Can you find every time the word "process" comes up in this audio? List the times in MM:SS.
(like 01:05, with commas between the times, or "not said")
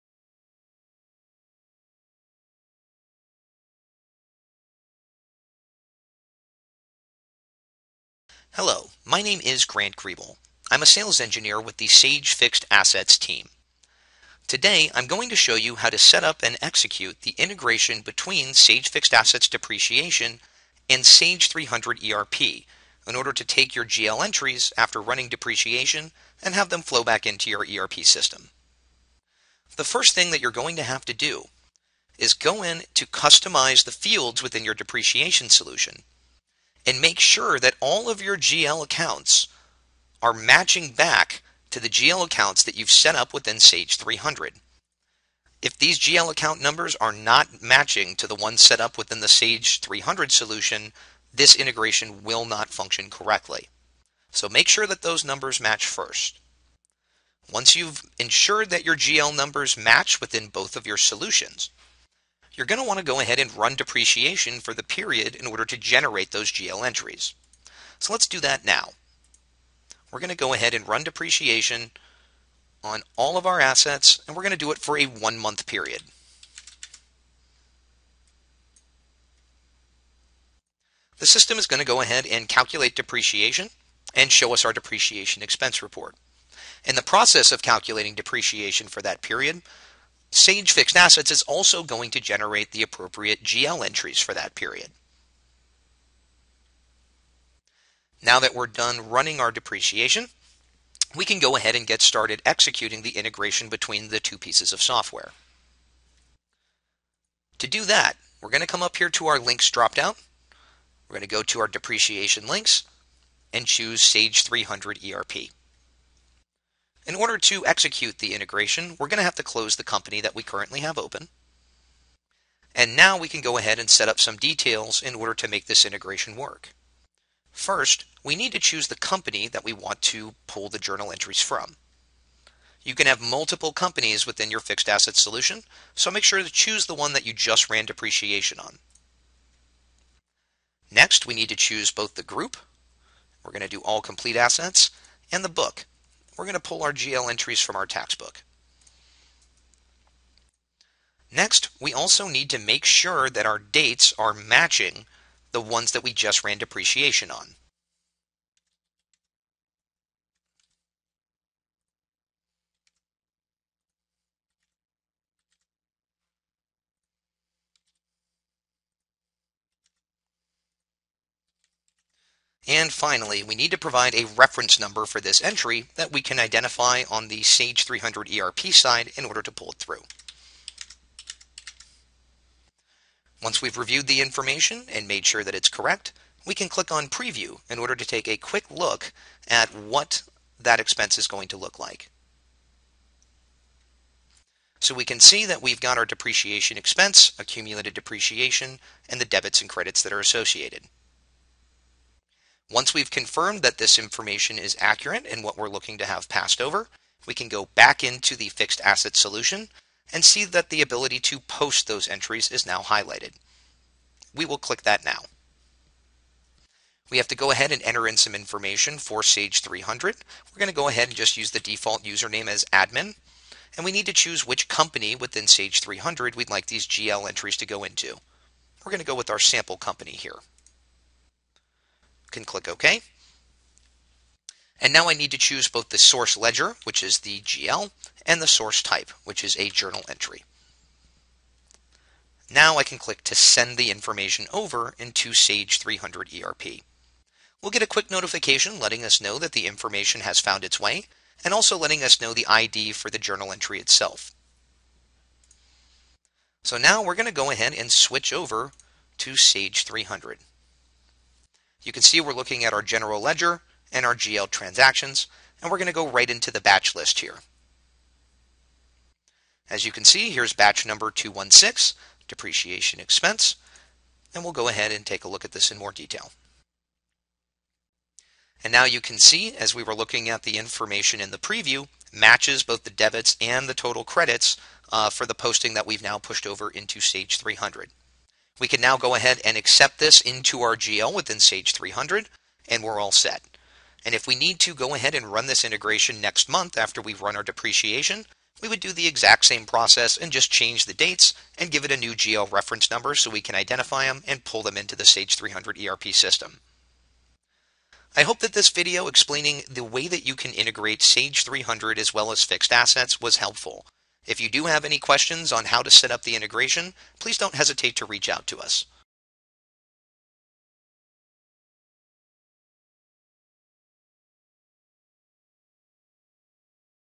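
01:27, 04:59.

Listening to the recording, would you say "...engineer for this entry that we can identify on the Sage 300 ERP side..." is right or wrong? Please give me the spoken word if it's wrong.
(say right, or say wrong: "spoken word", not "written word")
wrong: "number", not "engineer".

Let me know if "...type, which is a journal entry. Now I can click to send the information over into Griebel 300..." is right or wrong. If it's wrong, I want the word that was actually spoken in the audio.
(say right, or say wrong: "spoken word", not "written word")
wrong: "Sage", not "Griebel".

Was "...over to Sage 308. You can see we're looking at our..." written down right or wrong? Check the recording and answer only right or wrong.
wrong.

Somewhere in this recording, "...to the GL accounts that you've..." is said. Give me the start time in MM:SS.
00:41.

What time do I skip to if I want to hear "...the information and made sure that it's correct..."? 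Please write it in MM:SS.
03:04.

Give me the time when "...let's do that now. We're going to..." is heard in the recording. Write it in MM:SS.
01:08.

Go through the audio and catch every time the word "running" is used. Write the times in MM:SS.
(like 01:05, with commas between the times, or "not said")
00:25, 01:39.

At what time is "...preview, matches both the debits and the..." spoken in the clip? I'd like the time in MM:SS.
04:41.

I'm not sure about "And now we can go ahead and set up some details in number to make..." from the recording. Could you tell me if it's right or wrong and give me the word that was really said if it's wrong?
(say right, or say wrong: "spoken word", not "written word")
wrong: "order", not "number".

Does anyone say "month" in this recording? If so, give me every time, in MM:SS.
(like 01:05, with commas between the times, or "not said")
01:15, 04:56.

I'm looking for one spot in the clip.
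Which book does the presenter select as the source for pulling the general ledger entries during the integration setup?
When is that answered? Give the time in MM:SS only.
02:27.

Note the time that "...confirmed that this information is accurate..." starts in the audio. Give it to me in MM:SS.
03:23.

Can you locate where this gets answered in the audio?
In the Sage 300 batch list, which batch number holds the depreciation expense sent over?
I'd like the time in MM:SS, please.
04:31.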